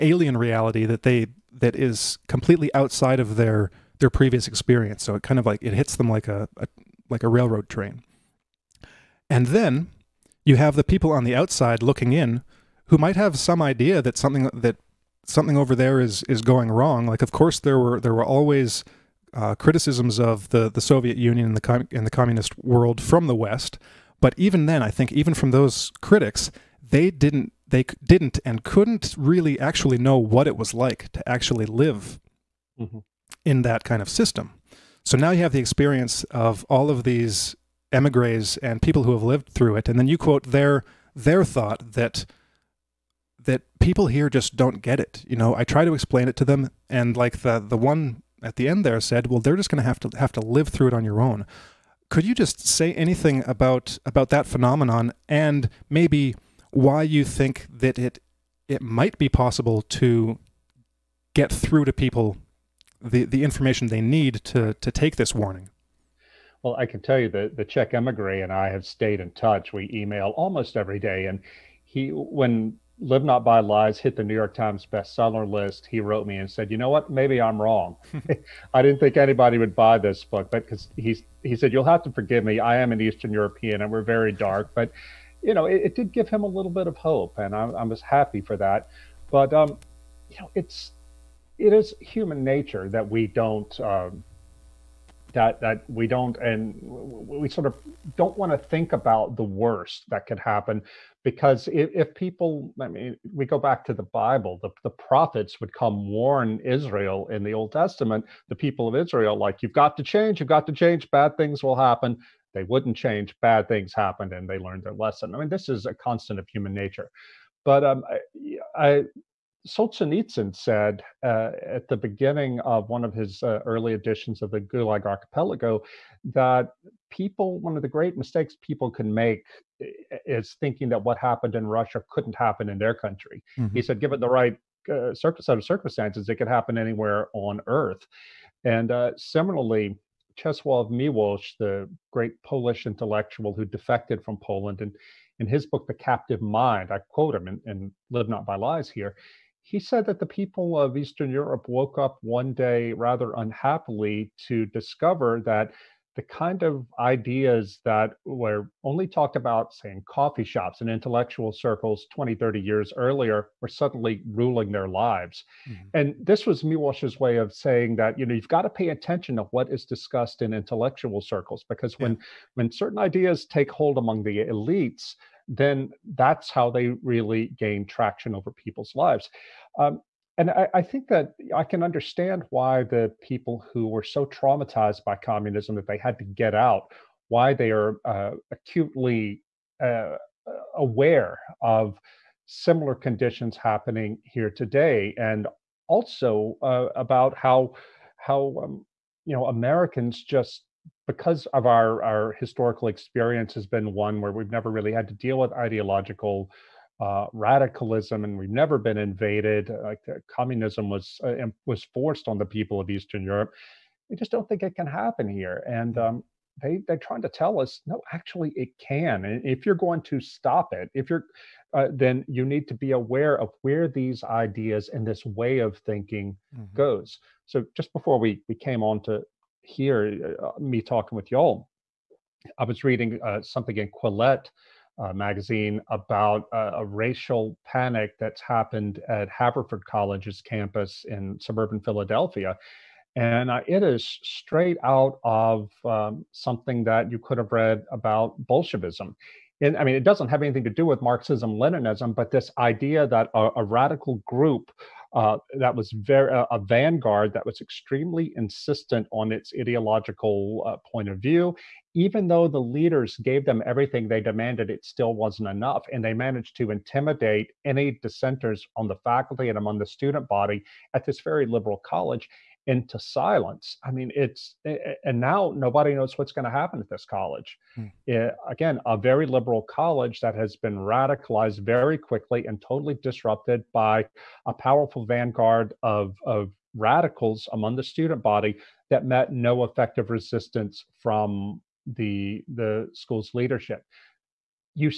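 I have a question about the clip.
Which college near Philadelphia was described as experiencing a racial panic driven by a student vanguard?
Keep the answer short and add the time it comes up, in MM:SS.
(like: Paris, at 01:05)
Haverford College, at 03:59.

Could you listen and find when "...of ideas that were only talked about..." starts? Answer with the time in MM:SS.
02:36.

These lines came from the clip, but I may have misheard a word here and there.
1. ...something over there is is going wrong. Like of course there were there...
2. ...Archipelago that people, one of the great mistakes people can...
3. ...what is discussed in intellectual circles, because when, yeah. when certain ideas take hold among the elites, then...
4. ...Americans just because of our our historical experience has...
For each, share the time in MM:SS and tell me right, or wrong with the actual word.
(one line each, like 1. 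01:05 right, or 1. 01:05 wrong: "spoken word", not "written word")
1. 00:15 right
2. 02:05 right
3. 02:49 right
4. 03:19 right.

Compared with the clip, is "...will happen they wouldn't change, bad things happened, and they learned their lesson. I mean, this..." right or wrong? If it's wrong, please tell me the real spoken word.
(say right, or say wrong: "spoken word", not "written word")
right.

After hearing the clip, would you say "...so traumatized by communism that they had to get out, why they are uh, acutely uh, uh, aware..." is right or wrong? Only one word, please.
right.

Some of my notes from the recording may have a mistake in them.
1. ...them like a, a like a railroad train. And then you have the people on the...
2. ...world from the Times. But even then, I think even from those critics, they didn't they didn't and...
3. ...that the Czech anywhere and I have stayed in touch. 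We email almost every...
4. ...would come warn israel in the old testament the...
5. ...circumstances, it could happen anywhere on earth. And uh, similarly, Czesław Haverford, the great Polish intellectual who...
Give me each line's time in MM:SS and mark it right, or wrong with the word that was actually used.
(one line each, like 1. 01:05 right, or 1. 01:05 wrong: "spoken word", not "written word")
1. 00:05 right
2. 00:22 wrong: "West", not "Times"
3. 01:07 wrong: "emigre", not "anywhere"
4. 01:45 right
5. 02:15 wrong: "Miłosz", not "Haverford".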